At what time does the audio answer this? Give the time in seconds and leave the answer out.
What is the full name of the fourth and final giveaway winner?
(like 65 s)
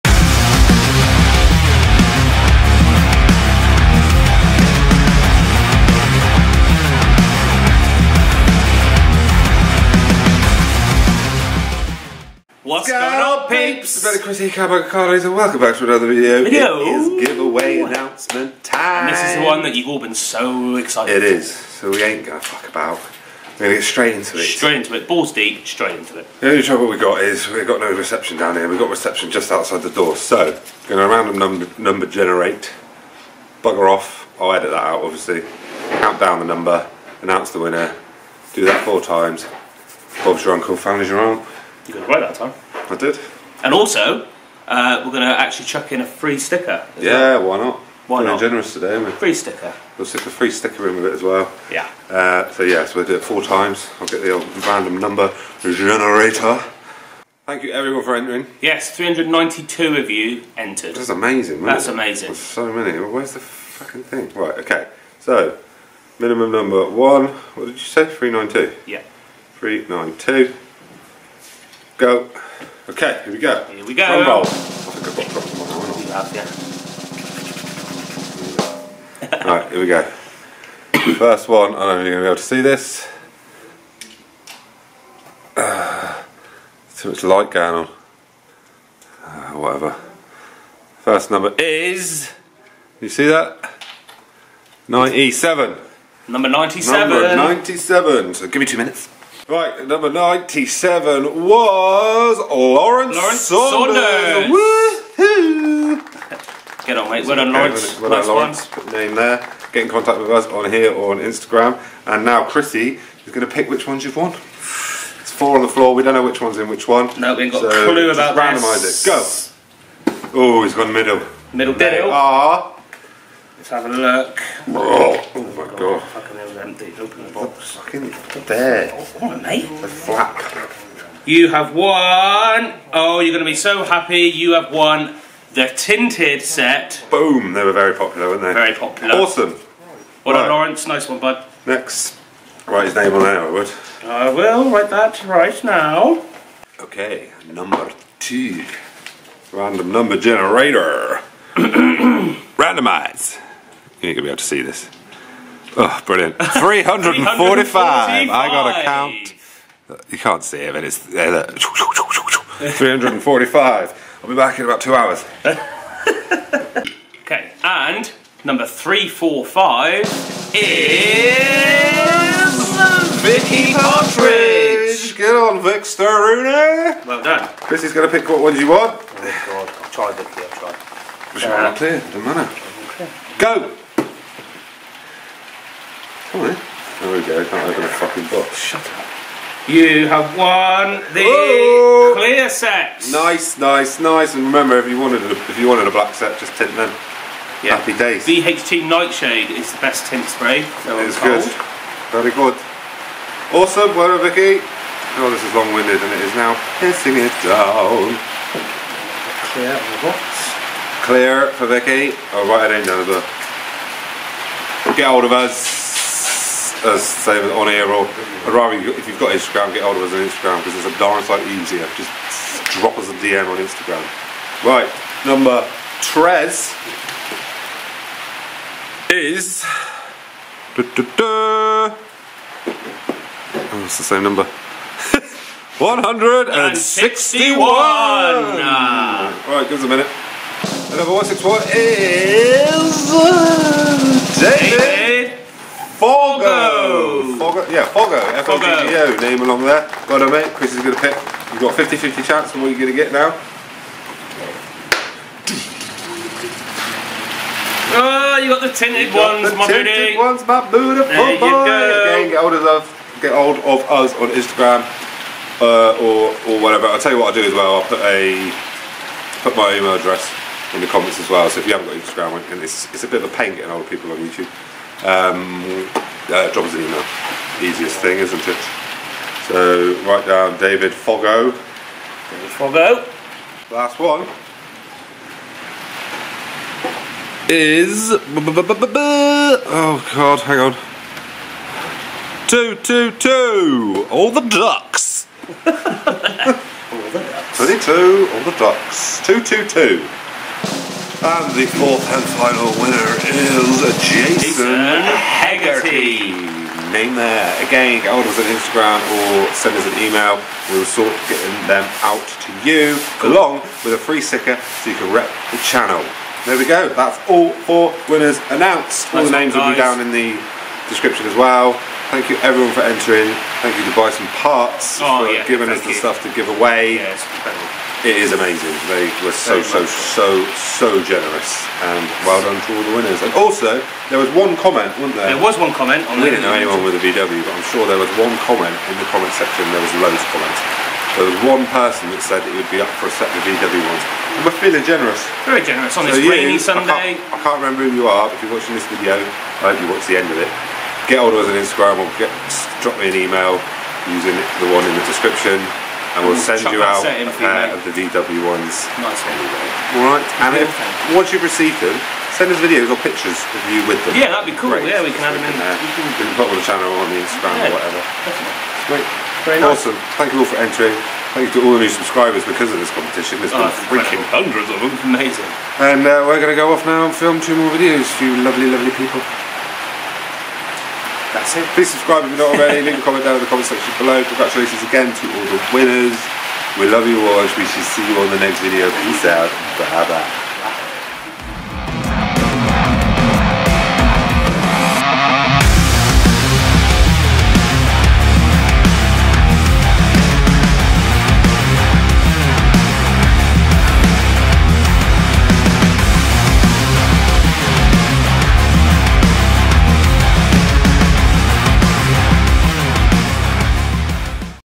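304 s.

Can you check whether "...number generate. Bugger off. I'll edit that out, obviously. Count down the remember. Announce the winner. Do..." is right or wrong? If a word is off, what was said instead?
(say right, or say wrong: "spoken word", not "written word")
wrong: "number", not "remember".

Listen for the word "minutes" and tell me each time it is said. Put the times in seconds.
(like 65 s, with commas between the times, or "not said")
98 s, 239 s.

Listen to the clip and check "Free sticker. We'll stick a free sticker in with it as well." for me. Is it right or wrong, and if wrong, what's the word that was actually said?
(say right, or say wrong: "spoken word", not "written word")
right.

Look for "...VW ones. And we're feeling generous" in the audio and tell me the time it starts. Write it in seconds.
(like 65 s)
343 s.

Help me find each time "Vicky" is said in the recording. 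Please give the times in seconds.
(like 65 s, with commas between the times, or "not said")
173 s, 180 s, 204 s, 211 s.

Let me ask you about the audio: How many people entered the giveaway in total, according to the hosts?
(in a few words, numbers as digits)
392.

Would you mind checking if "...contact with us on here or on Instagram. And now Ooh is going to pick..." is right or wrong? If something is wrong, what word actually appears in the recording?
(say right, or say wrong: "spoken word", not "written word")
wrong: "Chrissy", not "Ooh".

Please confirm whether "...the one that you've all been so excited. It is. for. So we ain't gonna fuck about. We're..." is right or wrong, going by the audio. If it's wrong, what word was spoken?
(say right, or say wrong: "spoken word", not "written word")
right.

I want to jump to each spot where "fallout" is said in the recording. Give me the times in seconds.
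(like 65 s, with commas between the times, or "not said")
not said.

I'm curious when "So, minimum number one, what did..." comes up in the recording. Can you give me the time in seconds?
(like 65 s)
65 s.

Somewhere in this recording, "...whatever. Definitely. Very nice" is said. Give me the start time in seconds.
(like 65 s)
367 s.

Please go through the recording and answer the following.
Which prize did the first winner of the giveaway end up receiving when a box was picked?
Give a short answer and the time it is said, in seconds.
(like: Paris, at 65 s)
The tinted set, at 135 s.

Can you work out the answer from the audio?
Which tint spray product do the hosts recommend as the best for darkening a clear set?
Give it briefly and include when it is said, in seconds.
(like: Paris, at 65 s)
VHT Nightshade, at 198 s.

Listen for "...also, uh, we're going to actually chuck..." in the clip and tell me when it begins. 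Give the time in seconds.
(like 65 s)
43 s.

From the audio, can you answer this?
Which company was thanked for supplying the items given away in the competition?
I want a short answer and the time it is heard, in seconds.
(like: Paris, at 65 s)
Bison Parts, at 323 s.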